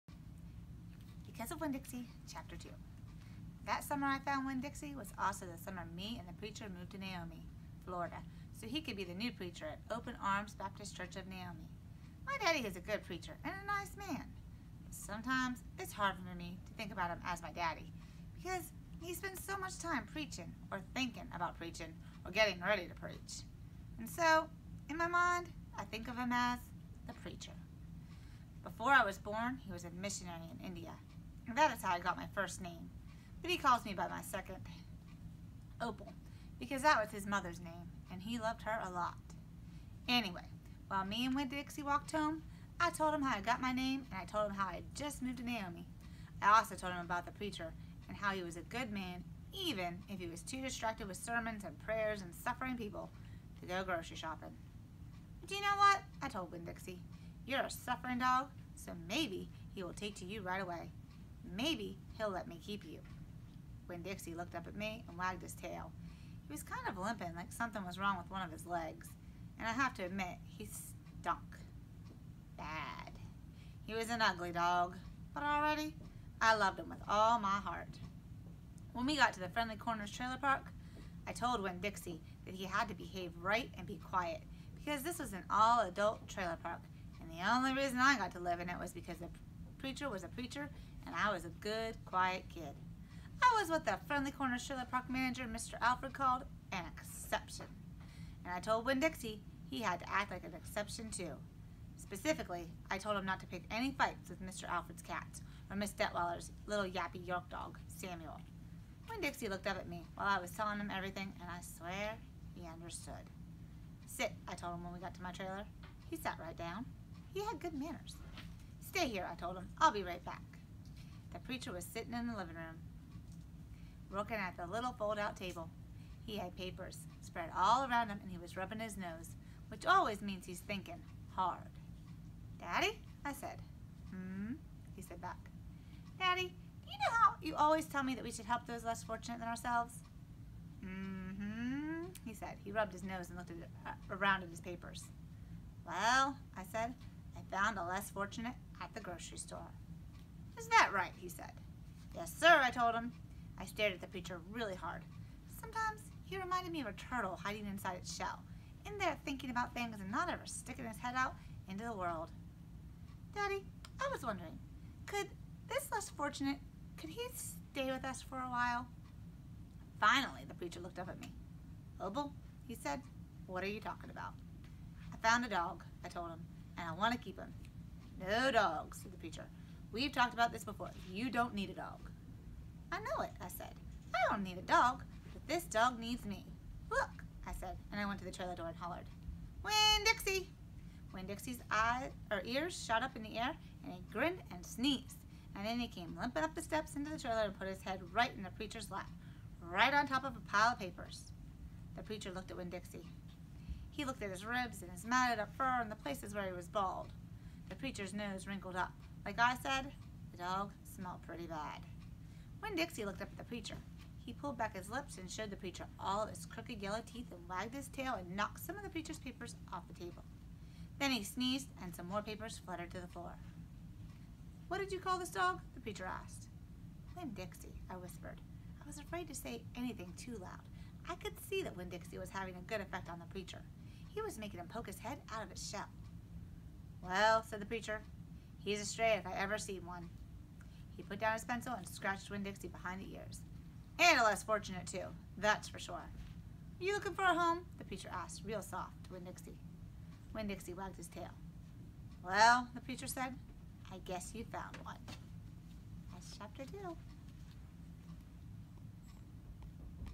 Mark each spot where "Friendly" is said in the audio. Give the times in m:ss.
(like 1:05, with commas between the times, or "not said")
1:19, 1:34.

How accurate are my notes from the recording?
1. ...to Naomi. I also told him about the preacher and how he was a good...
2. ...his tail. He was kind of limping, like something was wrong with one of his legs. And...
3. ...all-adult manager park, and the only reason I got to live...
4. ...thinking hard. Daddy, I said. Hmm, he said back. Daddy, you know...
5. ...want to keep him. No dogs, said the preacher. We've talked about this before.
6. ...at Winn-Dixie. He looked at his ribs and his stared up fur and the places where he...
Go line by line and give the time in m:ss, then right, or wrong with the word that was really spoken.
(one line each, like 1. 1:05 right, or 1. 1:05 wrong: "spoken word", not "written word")
1. 0:45 right
2. 1:05 right
3. 1:25 wrong: "trailer", not "manager"
4. 2:10 right
5. 2:56 right
6. 3:22 wrong: "matted", not "stared".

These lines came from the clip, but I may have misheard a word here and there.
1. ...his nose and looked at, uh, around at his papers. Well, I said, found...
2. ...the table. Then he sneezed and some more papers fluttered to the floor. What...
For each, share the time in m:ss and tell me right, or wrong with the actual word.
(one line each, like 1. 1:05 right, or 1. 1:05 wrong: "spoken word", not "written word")
1. 2:22 right
2. 3:39 right.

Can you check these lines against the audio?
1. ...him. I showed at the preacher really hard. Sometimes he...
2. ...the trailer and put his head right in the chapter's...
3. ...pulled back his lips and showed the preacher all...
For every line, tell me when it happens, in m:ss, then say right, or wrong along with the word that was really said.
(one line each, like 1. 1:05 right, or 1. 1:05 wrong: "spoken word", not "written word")
1. 2:32 wrong: "stared", not "showed"
2. 3:17 wrong: "preacher", not "chapter"
3. 3:34 right.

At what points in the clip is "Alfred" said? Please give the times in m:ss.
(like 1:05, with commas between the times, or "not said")
1:35, 1:44.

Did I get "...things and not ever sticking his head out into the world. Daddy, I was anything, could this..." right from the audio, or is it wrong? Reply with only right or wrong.
wrong.